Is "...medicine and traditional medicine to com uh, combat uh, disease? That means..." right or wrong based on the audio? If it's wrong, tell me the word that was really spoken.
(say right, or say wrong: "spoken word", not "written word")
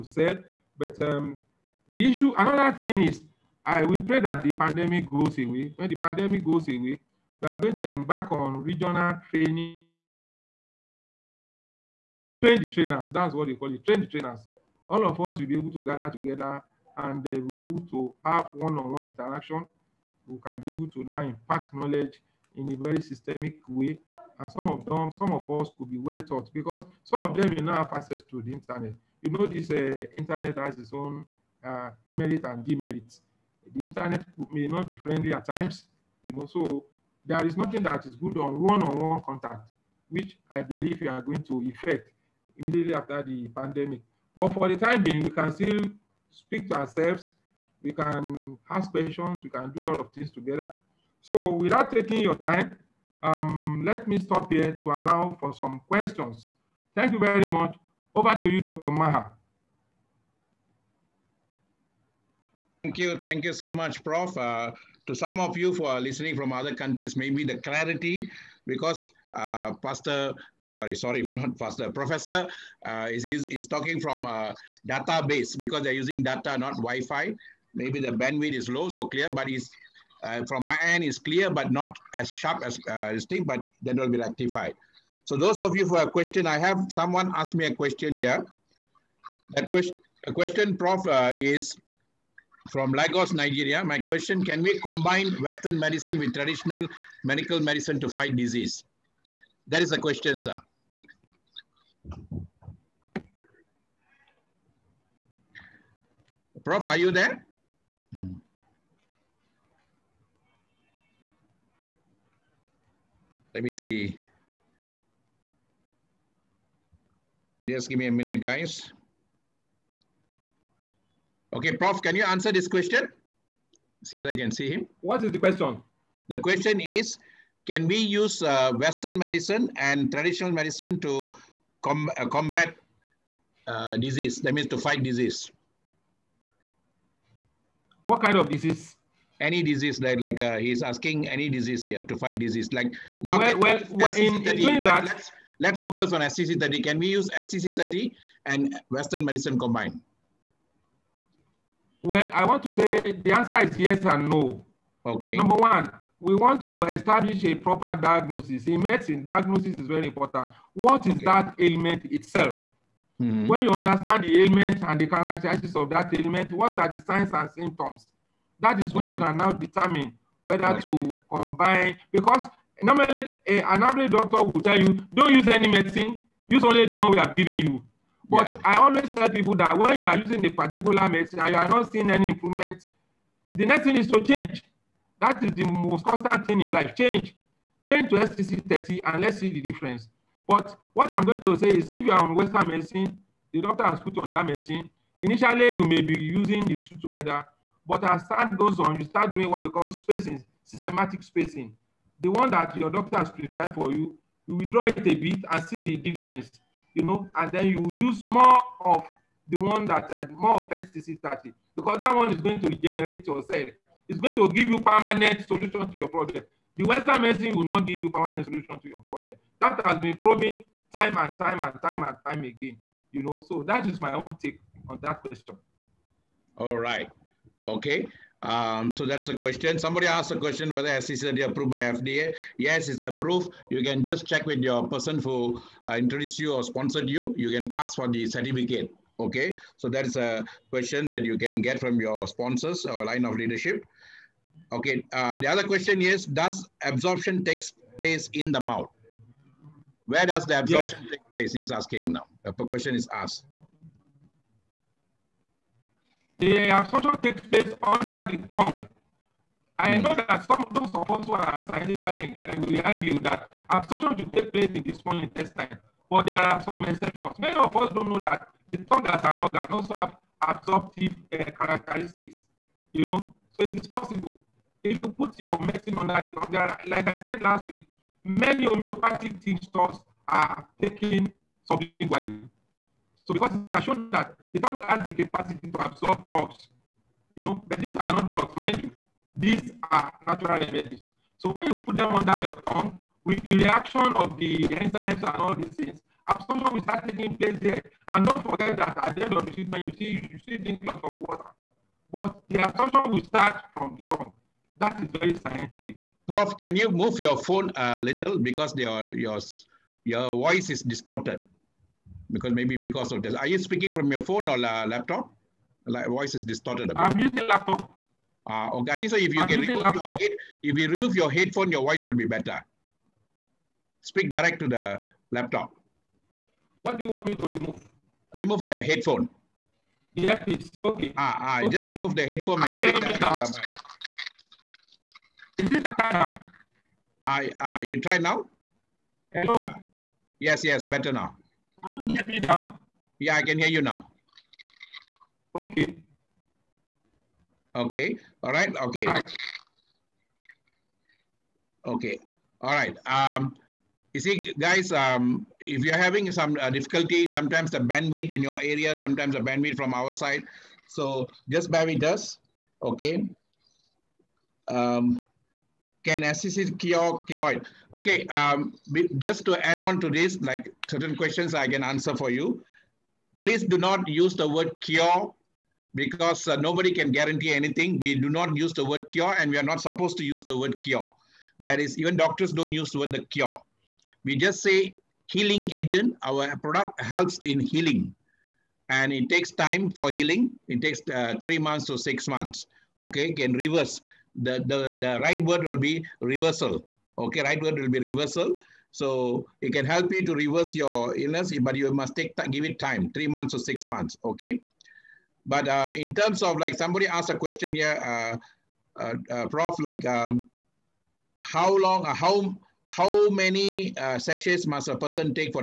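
right.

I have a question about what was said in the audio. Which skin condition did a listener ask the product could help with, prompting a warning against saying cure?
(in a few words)
keloid.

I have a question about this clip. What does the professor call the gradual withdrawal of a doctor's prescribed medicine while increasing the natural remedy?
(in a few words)
systematic spacing.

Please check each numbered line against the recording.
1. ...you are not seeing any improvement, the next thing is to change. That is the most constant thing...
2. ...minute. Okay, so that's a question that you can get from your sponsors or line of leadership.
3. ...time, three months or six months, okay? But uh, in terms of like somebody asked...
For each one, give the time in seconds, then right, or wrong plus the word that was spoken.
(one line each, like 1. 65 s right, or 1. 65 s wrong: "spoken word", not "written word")
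1. 181 s right
2. 238 s wrong: "certificate", not "minute"
3. 402 s right.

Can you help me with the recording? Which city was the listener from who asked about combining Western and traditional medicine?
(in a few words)
Lagos.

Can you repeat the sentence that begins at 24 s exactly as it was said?
And some of them, some of us could be well taught because some of them will now have access to the internet.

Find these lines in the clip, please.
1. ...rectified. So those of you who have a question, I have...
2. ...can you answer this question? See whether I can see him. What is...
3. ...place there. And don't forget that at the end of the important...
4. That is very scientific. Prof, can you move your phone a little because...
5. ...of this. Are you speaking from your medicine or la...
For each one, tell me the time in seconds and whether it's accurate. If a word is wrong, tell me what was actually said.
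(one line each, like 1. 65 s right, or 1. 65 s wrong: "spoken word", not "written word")
1. 84 s right
2. 122 s right
3. 297 s wrong: "treatment", not "important"
4. 304 s right
5. 313 s wrong: "phone", not "medicine".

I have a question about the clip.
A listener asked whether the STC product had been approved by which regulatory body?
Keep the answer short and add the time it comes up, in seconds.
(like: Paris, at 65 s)
FDA, at 231 s.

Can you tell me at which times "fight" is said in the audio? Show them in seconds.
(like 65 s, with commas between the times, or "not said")
98 s, 134 s, 142 s.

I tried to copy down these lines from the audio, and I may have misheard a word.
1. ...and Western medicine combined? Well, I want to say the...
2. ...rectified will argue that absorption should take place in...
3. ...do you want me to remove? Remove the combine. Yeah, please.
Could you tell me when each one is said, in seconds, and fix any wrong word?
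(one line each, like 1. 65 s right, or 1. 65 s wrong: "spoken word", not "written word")
1. 148 s right
2. 262 s wrong: "inclined", not "rectified"
3. 326 s wrong: "headphone", not "combine".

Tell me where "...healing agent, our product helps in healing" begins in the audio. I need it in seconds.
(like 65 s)
385 s.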